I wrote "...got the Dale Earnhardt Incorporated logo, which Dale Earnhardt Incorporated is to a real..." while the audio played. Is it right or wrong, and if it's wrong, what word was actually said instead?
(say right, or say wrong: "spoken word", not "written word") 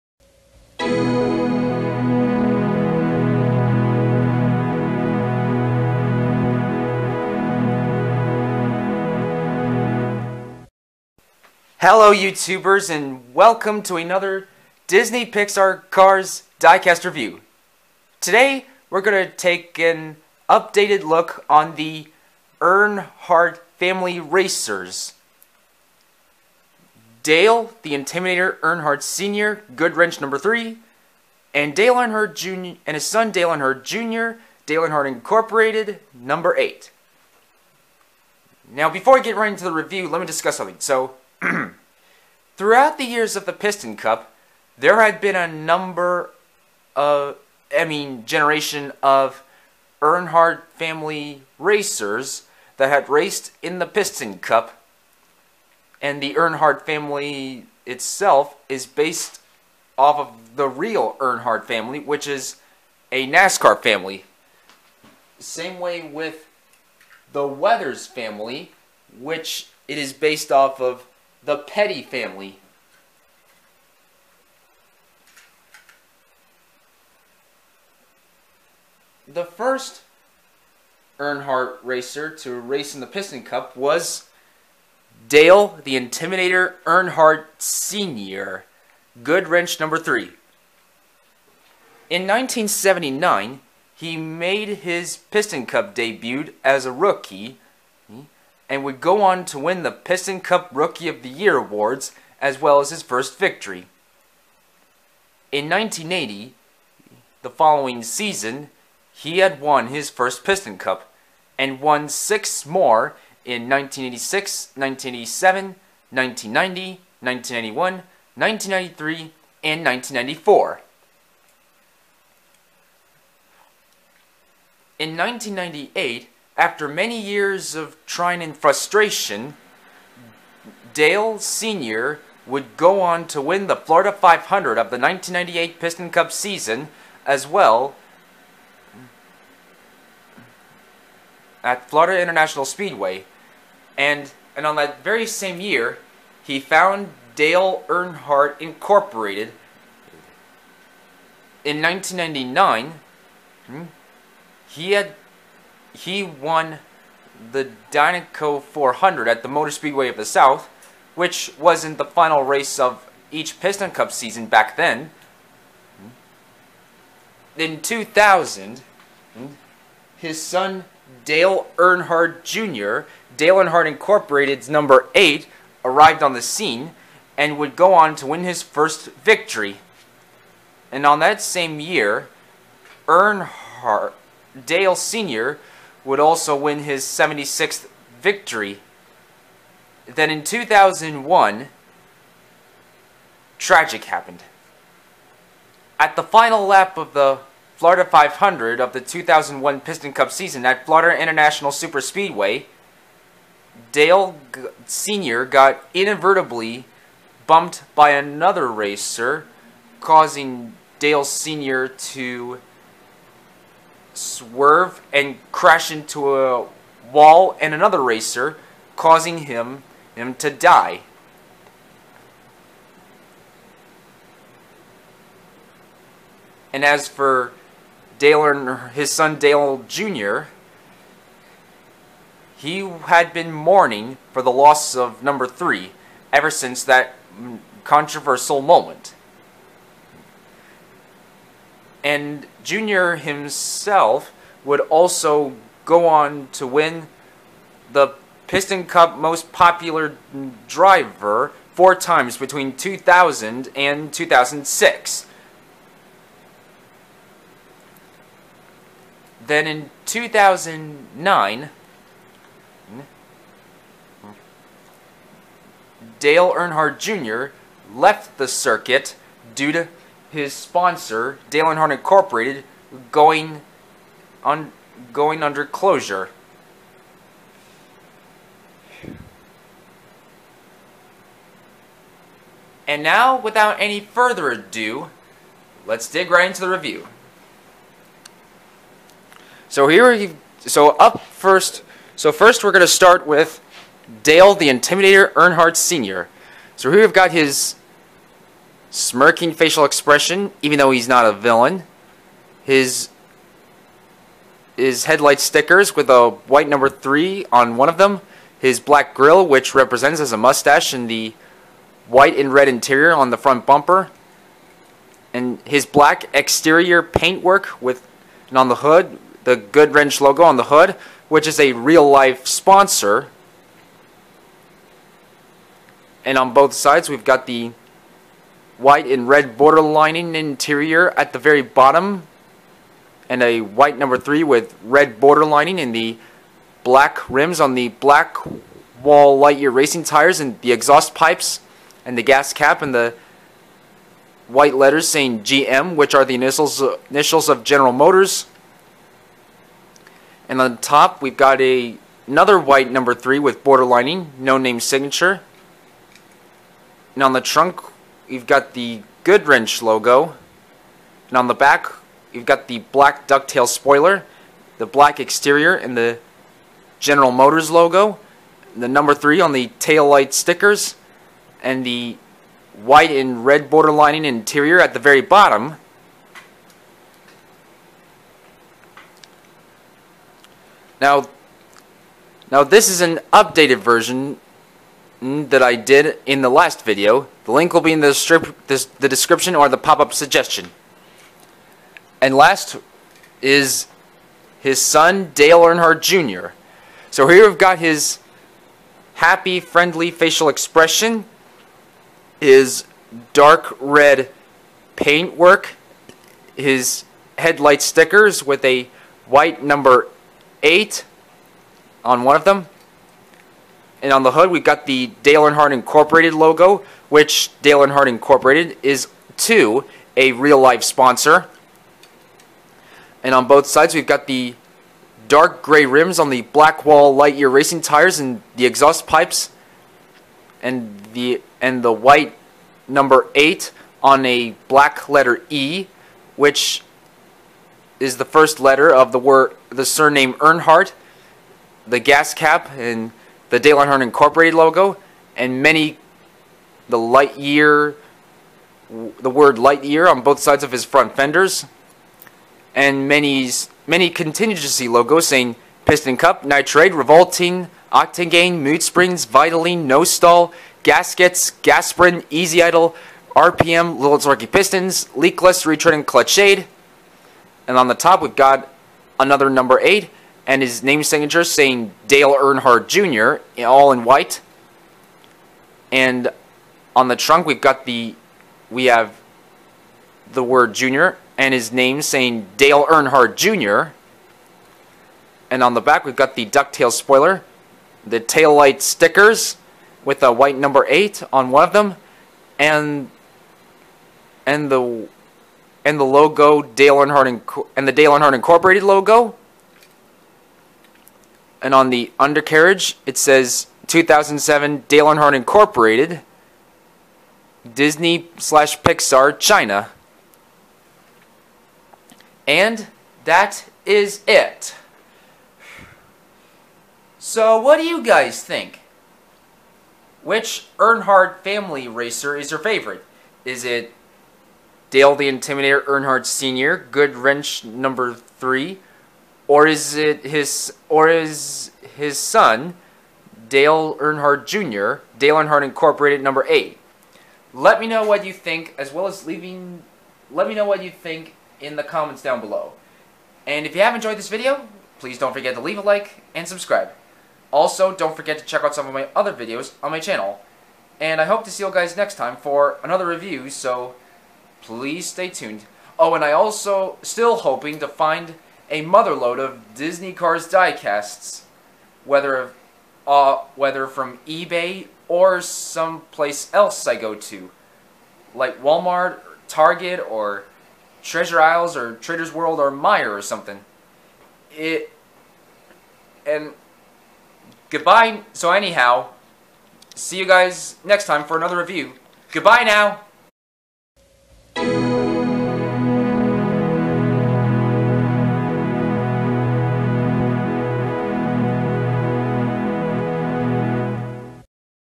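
right.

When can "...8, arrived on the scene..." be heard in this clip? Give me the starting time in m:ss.
2:55.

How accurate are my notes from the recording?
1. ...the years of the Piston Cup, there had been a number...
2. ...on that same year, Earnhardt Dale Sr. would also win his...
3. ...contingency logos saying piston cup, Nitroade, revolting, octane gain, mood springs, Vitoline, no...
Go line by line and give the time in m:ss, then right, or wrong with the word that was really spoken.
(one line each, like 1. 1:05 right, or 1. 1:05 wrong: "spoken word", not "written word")
1. 0:42 right
2. 3:01 right
3. 7:34 right.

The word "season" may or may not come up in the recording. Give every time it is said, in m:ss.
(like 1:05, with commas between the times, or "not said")
1:48, 2:16, 2:44, 3:20.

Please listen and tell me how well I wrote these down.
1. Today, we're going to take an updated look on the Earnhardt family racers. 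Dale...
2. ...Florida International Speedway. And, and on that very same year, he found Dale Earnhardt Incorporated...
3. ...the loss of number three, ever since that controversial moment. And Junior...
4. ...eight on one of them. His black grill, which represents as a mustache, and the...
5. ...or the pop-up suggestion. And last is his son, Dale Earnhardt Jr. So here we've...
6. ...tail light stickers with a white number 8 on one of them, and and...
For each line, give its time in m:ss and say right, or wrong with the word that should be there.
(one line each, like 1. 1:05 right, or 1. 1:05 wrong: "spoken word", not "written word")
1. 0:18 right
2. 2:21 right
3. 3:54 right
4. 5:06 wrong: "three", not "eight"
5. 6:29 right
6. 8:08 right.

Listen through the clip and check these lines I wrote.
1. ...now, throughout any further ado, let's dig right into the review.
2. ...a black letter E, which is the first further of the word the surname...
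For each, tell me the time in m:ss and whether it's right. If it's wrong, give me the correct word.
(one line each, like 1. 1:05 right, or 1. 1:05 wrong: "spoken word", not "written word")
1. 4:43 wrong: "without", not "throughout"
2. 7:14 wrong: "letter", not "further".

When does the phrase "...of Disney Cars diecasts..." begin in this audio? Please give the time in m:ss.
9:19.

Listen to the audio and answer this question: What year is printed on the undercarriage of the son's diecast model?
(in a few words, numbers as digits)
2007.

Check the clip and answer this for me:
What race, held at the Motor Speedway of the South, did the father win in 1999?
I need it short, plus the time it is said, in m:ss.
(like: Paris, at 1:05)
Dynaco 400, at 2:37.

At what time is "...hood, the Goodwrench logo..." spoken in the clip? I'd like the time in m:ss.
5:18.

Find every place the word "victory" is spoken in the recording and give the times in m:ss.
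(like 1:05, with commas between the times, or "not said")
1:43, 2:59, 3:08.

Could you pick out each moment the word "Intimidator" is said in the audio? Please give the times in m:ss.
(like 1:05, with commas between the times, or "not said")
0:27, 1:25, 4:54, 8:45.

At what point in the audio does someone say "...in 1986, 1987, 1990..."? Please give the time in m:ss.
1:53.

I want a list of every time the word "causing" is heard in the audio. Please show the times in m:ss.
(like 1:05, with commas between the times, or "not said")
3:29, 3:38.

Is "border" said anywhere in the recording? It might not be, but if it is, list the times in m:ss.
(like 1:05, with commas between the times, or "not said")
5:29, 5:35, 5:53, 6:13.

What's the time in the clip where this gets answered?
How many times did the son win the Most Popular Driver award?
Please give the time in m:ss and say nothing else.
4:11.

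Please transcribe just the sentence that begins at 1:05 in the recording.
Same way with the Weathers family, which it is based off of the Petty family.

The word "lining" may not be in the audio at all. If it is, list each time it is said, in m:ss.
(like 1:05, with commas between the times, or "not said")
5:29, 5:35, 5:53, 6:13.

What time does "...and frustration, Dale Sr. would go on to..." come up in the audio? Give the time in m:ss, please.
2:08.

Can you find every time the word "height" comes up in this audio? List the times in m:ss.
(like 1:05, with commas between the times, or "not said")
not said.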